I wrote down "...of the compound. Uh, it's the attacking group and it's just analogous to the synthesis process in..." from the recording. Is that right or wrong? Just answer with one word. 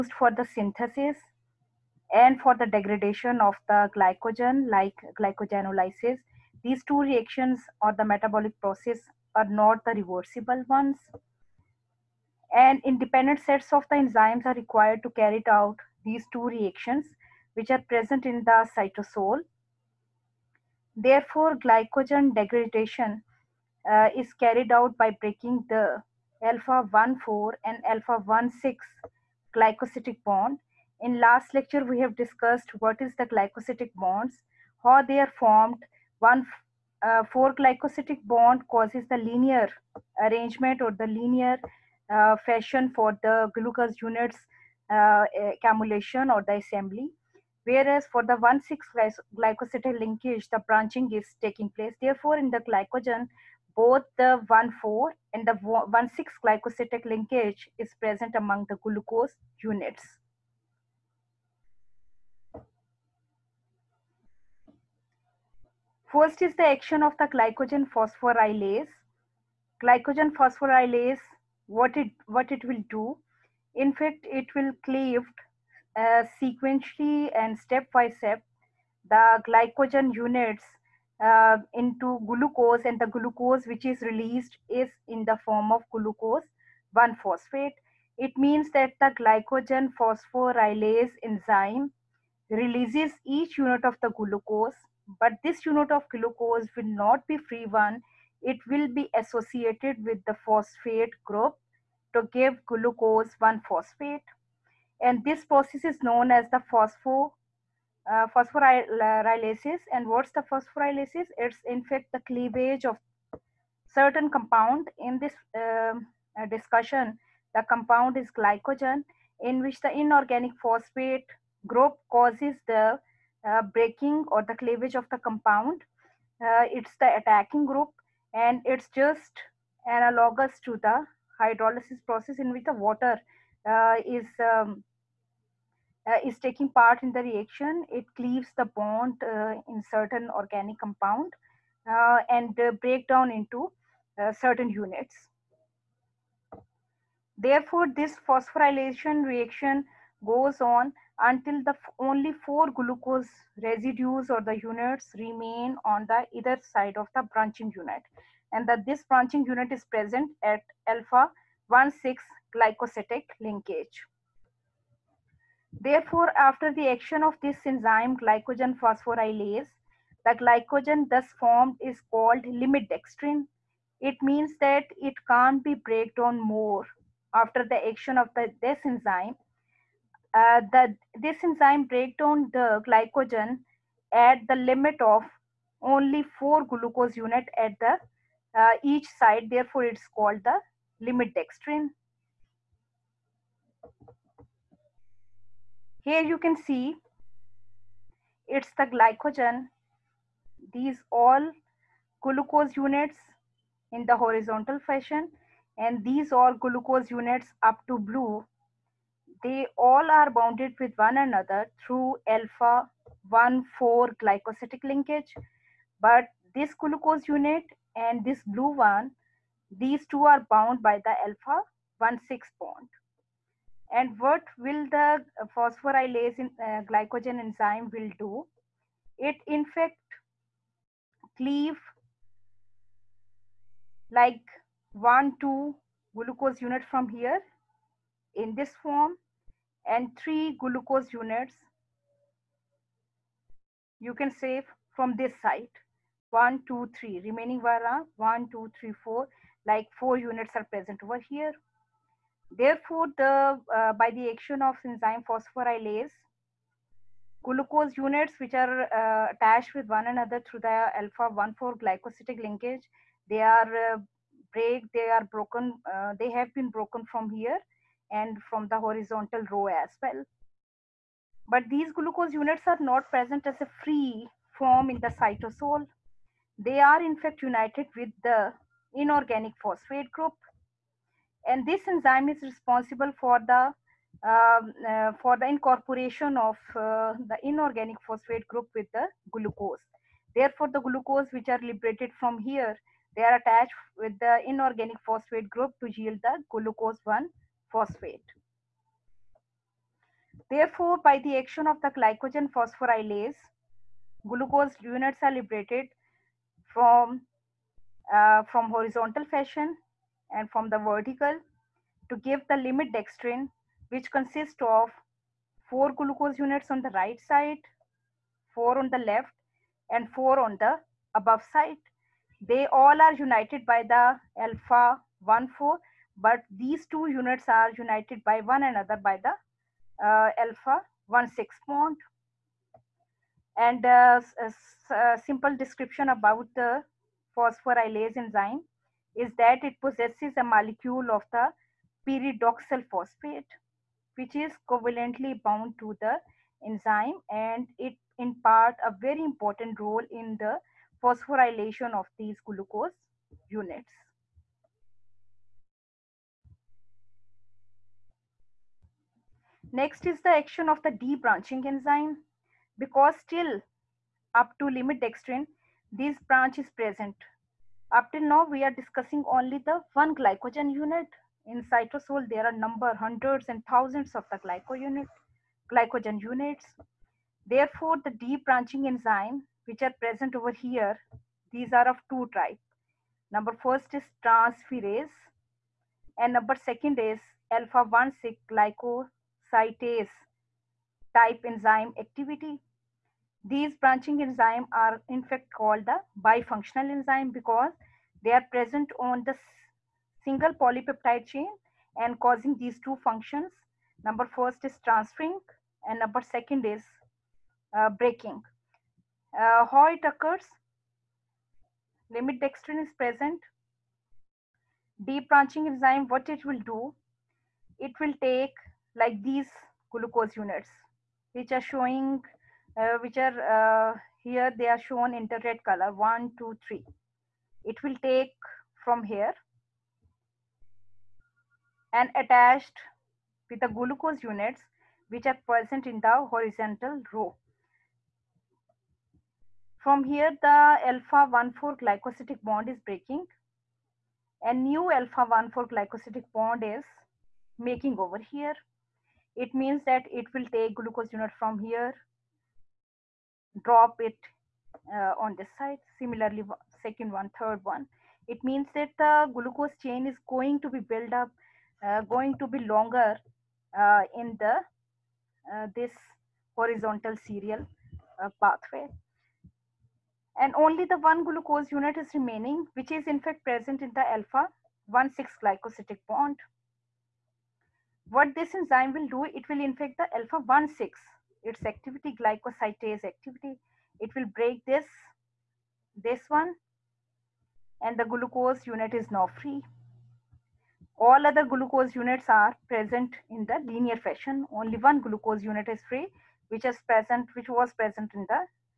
wrong.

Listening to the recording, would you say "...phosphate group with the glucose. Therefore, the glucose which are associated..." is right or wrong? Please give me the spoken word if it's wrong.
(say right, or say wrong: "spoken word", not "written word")
wrong: "liberated", not "associated".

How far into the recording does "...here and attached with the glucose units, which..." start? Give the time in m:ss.
7:09.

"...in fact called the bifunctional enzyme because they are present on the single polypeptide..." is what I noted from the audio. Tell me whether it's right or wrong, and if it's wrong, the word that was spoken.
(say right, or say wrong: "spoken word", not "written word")
right.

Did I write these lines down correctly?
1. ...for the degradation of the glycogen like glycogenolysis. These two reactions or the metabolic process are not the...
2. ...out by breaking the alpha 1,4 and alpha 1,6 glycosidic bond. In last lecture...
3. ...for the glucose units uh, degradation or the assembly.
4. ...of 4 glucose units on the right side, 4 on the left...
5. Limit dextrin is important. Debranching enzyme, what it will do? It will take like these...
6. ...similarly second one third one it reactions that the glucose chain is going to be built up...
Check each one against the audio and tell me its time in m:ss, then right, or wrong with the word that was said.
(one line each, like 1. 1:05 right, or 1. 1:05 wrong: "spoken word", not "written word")
1. 0:02 right
2. 0:24 right
3. 0:42 wrong: "accumulation", not "degradation"
4. 5:14 right
5. 6:52 wrong: "present", not "important"
6. 7:35 wrong: "means", not "reactions".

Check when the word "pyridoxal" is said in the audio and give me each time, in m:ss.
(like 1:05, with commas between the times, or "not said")
5:42.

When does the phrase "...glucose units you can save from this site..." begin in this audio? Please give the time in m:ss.
4:00.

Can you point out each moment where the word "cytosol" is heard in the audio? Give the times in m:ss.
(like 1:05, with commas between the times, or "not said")
0:18, 4:35, 6:11.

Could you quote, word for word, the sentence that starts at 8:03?
It will break this, this one, and the glucose unit is now free.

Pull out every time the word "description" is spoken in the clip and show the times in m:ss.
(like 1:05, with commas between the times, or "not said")
5:35.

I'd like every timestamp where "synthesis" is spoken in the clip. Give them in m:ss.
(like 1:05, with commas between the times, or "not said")
0:00.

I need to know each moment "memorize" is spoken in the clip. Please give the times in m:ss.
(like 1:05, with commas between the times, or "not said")
not said.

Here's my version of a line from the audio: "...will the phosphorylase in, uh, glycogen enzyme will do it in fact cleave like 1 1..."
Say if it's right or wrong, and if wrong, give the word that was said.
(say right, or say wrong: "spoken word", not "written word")
wrong: "2", not "1".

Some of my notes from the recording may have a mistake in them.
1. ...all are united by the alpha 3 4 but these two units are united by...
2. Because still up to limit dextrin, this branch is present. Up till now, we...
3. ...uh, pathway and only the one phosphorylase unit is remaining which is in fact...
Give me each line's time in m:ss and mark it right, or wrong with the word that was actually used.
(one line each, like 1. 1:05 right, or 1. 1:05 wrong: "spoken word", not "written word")
1. 5:22 wrong: "1", not "3"
2. 6:02 right
3. 7:48 wrong: "glucose", not "phosphorylase".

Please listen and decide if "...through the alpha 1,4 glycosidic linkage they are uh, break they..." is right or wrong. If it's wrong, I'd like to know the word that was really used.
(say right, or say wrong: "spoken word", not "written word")
right.